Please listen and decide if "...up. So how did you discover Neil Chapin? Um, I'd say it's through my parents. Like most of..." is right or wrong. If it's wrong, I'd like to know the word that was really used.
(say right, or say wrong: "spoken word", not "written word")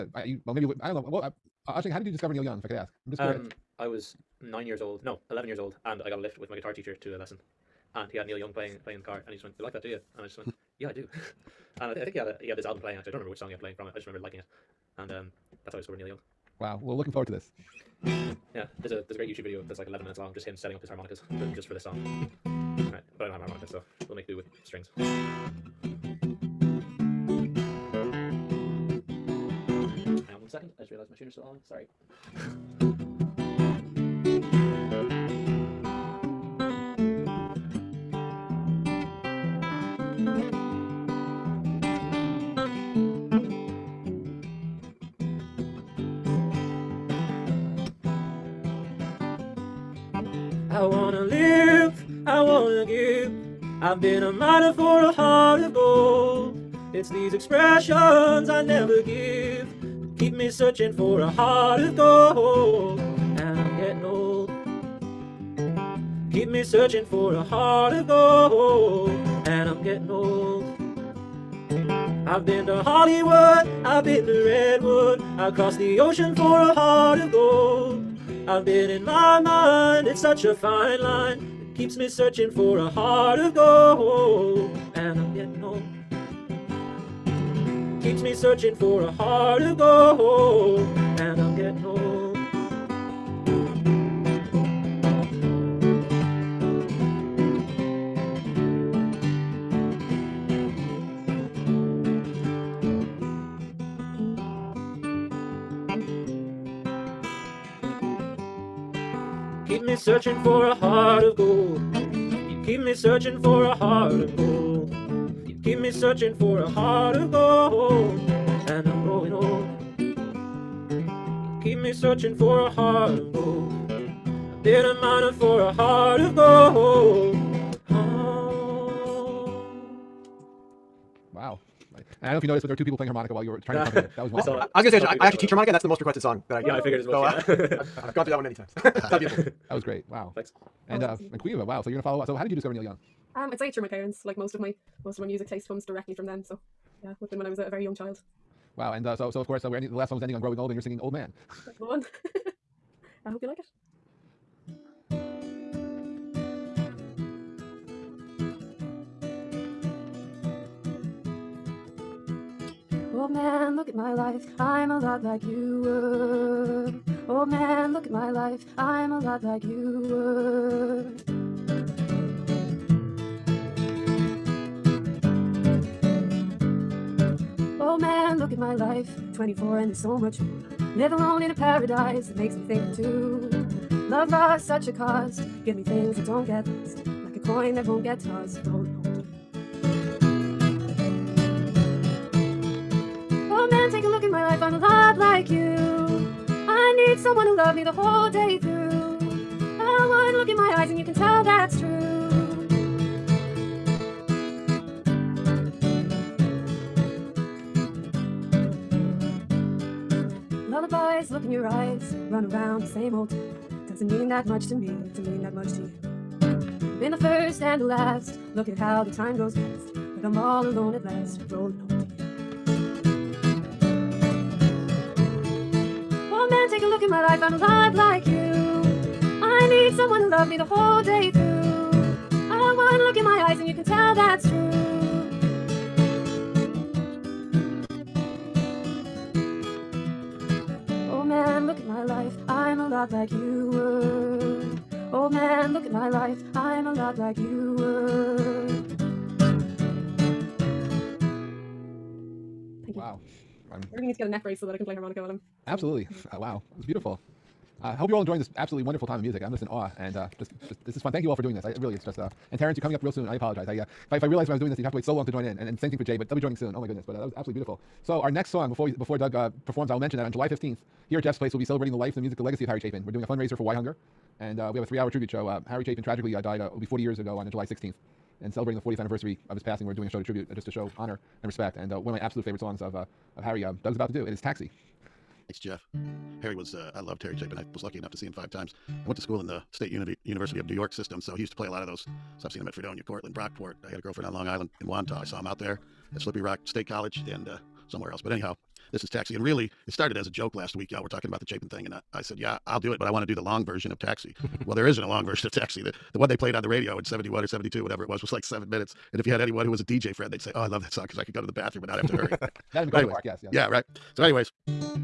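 wrong: "Young", not "Chapin".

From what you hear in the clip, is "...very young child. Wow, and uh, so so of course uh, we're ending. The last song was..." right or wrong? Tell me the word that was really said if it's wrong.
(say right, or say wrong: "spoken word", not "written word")
right.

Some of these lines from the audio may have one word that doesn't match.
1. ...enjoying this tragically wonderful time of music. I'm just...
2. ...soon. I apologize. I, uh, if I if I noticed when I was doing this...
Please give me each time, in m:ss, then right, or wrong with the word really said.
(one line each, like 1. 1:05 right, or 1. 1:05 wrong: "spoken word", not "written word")
1. 4:18 wrong: "absolutely", not "tragically"
2. 4:23 wrong: "realized", not "noticed".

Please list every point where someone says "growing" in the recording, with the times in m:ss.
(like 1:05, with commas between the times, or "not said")
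2:30.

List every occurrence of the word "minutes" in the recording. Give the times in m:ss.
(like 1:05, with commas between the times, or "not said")
0:20, 5:08.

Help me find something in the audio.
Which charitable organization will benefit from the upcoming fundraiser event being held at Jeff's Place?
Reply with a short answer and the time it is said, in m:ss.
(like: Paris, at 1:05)
WhyHunger, at 4:33.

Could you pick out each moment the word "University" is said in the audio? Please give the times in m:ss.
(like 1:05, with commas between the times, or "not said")
4:50.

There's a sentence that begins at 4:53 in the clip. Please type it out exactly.
I had a girlfriend on Long Island in Wantagh.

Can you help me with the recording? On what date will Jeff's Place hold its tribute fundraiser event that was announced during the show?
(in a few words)
July 15.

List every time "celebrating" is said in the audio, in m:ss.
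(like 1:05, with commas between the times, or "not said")
4:31, 4:38.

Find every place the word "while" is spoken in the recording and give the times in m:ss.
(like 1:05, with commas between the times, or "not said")
2:13, 4:15.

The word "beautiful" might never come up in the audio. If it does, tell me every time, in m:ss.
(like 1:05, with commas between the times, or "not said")
2:19, 4:16, 4:27.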